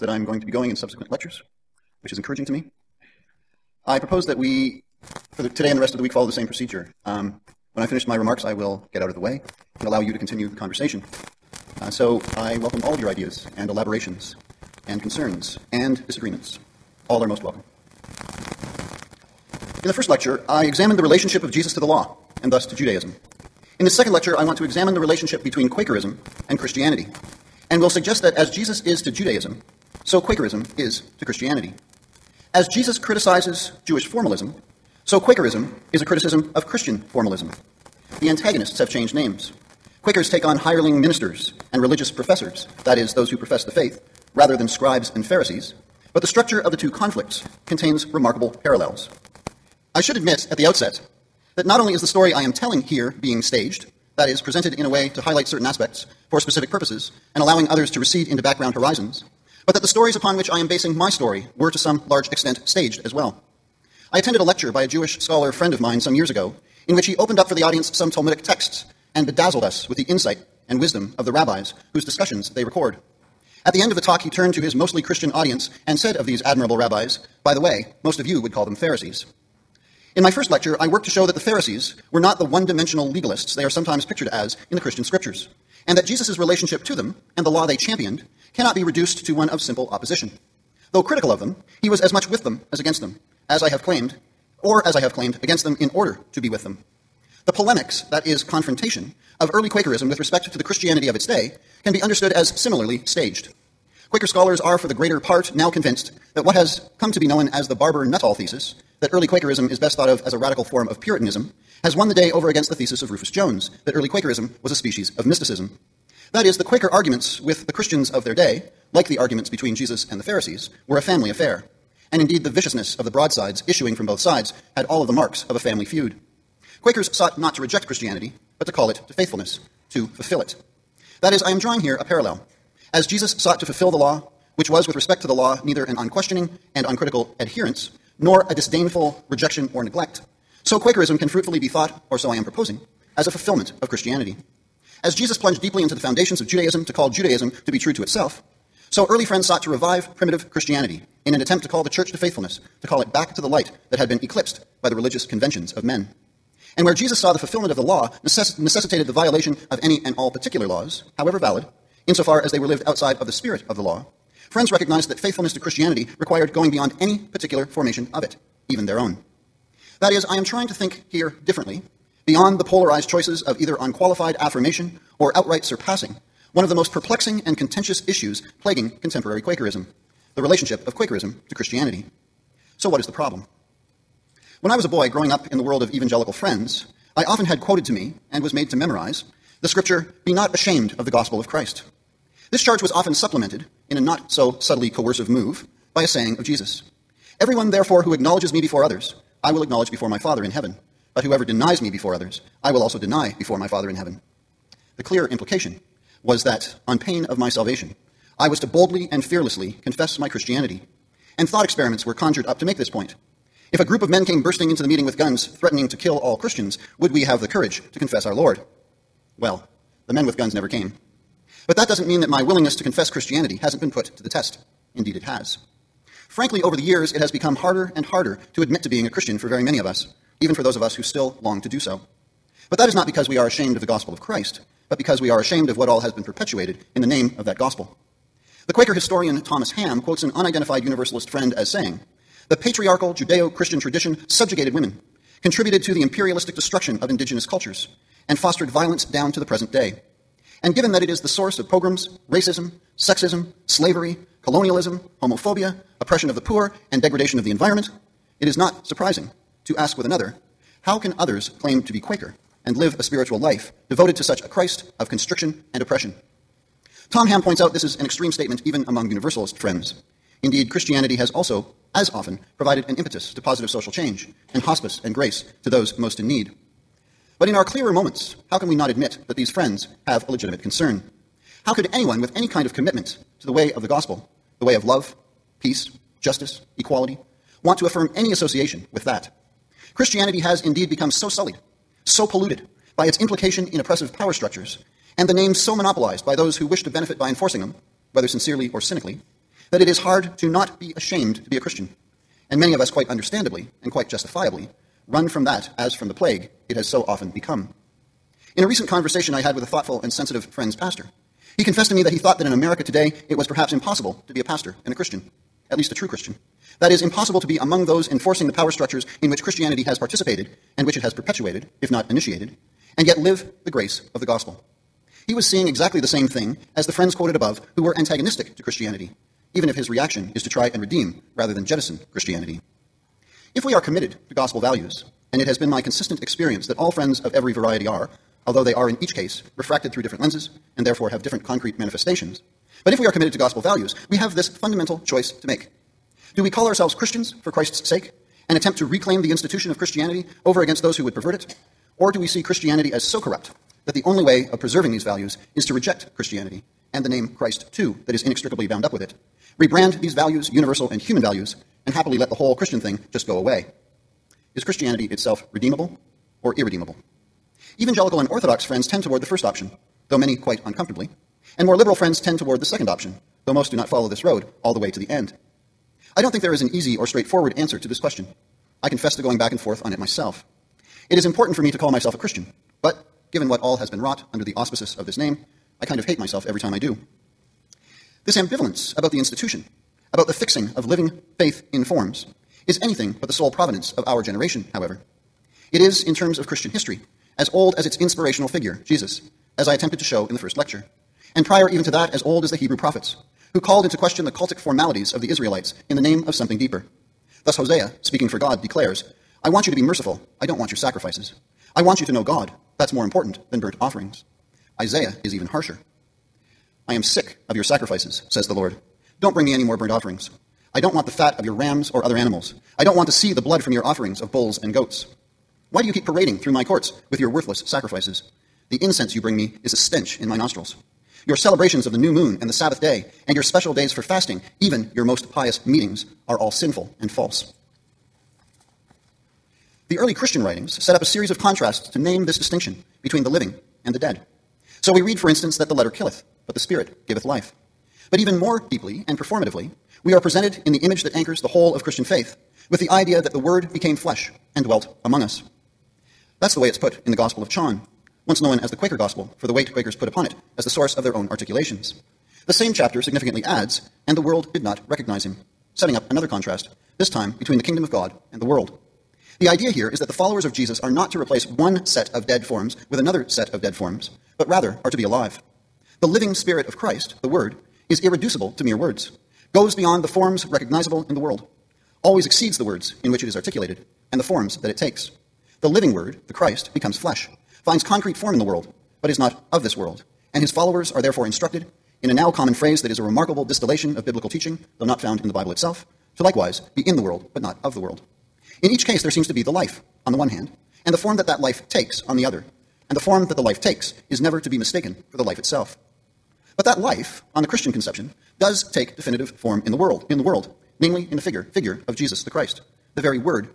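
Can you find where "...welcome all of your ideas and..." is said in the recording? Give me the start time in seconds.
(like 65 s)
12 s.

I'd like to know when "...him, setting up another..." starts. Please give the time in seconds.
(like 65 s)
465 s.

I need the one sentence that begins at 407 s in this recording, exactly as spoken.
Thus, Hosea, speaking for God, declares, I want you to be merciful.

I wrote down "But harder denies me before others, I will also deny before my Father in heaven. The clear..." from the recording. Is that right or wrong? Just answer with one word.
wrong.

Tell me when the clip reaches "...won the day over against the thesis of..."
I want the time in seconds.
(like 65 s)
111 s.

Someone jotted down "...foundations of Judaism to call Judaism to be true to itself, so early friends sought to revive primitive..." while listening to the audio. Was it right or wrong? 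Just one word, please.
right.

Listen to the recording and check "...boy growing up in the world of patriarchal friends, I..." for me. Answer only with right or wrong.
wrong.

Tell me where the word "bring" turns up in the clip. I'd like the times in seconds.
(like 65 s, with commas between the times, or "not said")
419 s, 429 s.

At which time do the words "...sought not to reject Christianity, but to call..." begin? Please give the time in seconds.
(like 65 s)
127 s.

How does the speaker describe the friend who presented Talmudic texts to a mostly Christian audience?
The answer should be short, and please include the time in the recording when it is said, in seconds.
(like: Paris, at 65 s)
Jewish scholar, at 64 s.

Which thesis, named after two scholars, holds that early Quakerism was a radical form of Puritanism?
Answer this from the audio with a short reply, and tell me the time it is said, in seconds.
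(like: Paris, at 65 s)
Barbour-Nuttall thesis, at 107 s.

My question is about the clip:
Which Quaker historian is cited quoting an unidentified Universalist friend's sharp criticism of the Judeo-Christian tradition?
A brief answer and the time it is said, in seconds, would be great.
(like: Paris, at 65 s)
Thomas Hamm, at 239 s.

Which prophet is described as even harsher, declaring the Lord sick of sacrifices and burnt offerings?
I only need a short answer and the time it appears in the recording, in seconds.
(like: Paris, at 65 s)
Isaiah, at 414 s.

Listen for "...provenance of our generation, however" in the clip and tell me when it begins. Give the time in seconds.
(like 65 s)
393 s.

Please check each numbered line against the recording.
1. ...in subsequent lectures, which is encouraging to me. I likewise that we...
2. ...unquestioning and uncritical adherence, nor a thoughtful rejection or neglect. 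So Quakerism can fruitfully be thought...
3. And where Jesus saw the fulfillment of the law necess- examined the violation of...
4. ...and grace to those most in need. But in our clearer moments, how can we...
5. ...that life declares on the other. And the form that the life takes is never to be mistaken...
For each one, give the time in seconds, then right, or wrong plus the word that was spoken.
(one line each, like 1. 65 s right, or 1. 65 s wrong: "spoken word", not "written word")
1. 0 s wrong: "propose", not "likewise"
2. 135 s wrong: "disdainful", not "thoughtful"
3. 156 s wrong: "necessitated", not "examined"
4. 275 s right
5. 501 s wrong: "takes", not "declares".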